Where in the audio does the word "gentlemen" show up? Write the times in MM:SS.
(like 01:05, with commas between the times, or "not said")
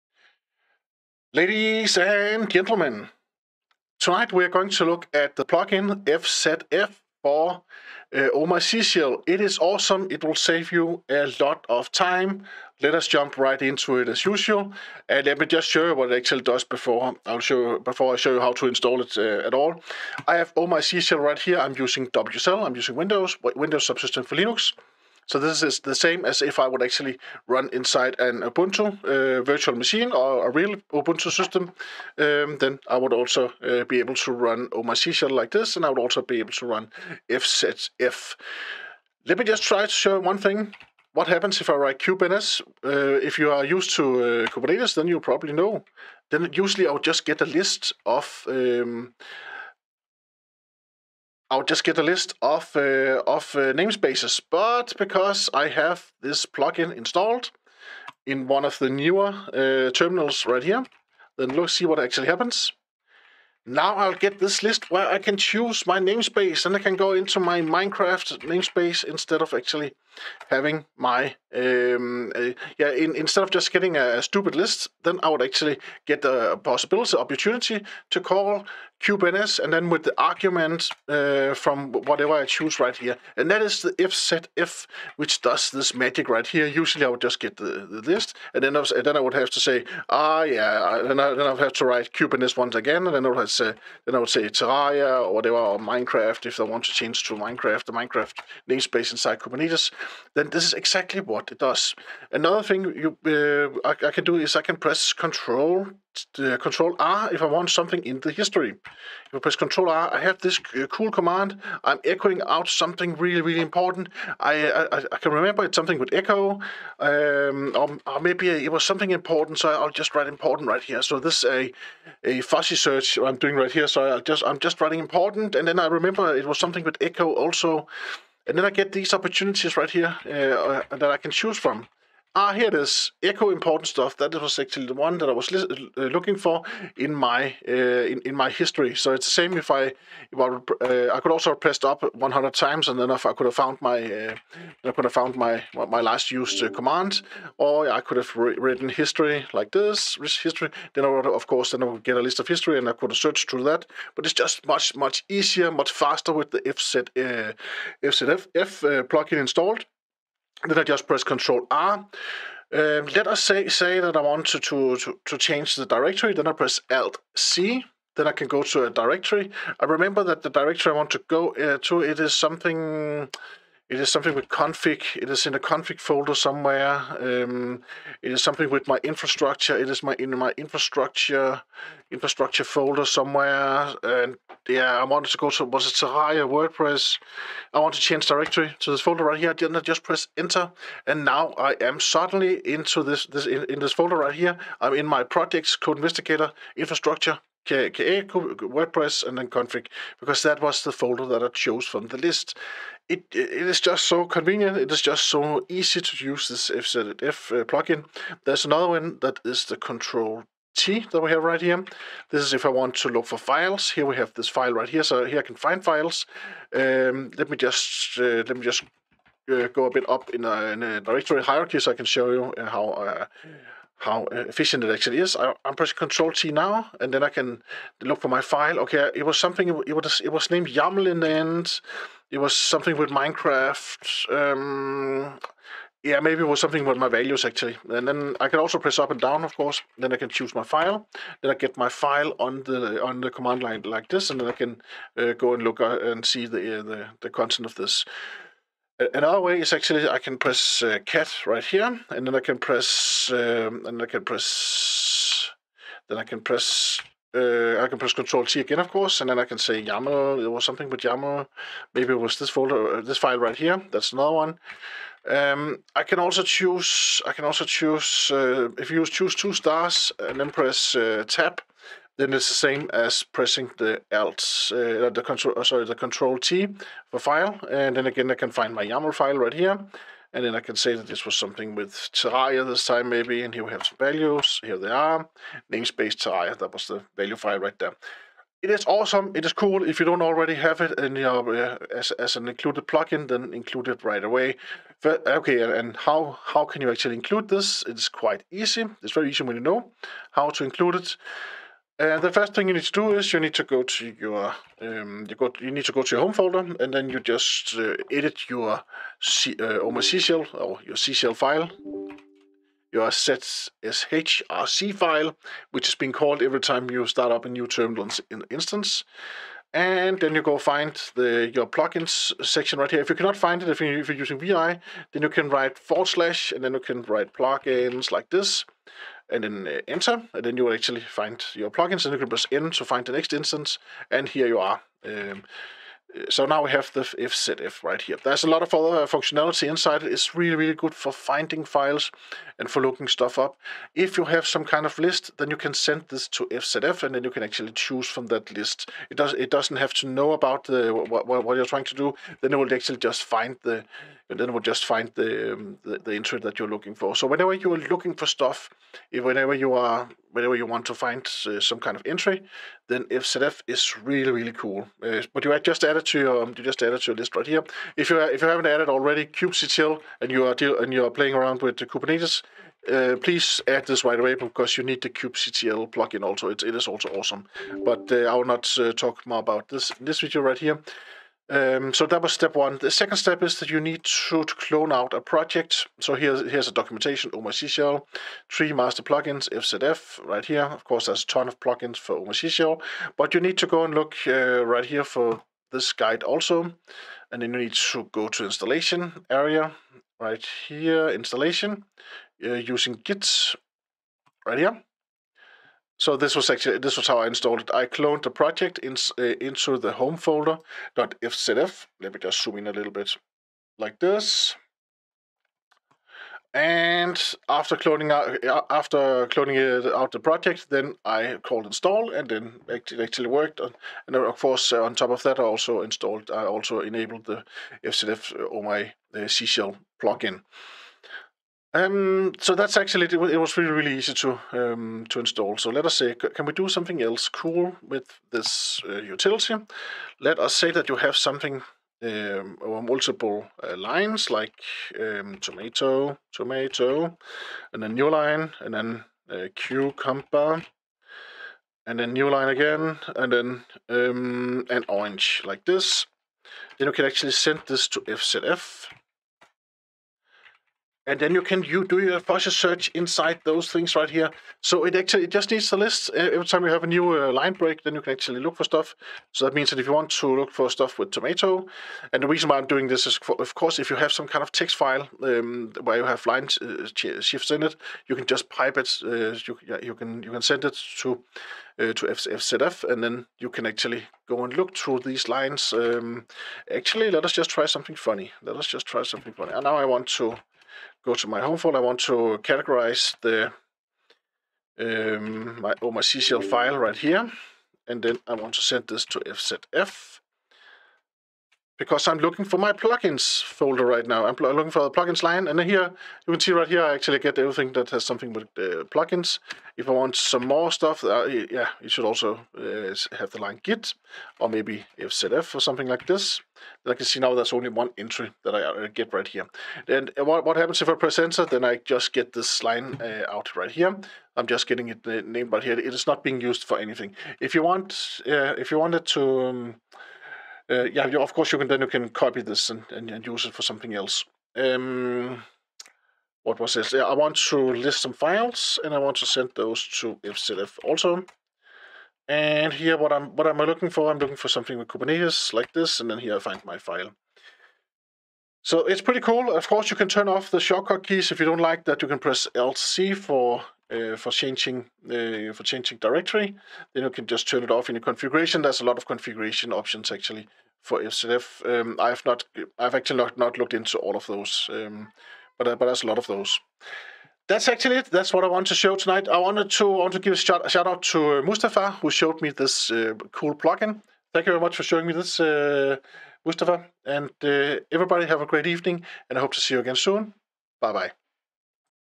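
00:02.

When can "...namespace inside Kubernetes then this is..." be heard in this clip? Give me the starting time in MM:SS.
01:38.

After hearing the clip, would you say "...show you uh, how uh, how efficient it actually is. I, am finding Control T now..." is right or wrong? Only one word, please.
wrong.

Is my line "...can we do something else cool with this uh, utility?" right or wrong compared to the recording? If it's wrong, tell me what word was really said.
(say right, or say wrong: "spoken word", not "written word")
right.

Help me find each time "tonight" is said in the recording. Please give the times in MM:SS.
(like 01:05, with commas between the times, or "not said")
00:04, 09:28.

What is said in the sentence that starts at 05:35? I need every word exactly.
Um, so now we have the fzf right here.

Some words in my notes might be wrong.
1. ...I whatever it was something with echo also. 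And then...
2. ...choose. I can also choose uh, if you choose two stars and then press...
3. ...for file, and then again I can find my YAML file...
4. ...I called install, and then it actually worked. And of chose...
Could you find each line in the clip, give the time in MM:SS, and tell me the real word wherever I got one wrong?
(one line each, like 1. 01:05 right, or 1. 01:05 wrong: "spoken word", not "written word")
1. 02:05 wrong: "remember", not "whatever"
2. 04:26 right
3. 04:37 right
4. 07:01 wrong: "course", not "chose".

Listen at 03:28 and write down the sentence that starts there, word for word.
There's another one that is the control T that we have right here.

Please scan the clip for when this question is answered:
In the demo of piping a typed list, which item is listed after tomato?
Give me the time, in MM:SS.
07:29.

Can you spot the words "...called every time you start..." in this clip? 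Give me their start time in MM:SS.
05:16.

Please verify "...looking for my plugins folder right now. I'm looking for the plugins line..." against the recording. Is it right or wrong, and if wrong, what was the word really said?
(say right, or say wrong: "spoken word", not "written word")
right.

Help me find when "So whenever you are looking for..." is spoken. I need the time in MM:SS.
05:57.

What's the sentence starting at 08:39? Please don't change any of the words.
And uh, what, what happens if I press enter?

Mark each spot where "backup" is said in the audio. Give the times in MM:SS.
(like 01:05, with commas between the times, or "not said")
not said.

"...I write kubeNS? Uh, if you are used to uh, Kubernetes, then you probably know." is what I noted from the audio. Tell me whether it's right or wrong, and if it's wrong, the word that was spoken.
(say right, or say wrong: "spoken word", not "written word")
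right.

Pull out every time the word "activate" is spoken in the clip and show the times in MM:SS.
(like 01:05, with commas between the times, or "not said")
not said.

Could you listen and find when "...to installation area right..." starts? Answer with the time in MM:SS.
06:38.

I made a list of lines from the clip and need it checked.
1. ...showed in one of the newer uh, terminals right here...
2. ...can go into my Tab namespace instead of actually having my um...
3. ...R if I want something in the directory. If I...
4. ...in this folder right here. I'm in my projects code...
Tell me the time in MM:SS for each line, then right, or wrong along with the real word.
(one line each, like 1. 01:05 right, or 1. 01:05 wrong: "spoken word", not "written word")
1. 00:56 wrong: "installed", not "showed"
2. 01:06 wrong: "Minecraft", not "Tab"
3. 01:46 wrong: "history", not "directory"
4. 03:13 right.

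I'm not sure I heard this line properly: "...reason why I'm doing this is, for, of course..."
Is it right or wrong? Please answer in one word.
right.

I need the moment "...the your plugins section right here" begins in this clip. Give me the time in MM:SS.
05:21.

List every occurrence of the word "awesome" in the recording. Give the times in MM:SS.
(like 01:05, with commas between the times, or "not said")
00:09, 04:48, 06:17.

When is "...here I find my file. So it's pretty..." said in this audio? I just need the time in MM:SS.
09:06.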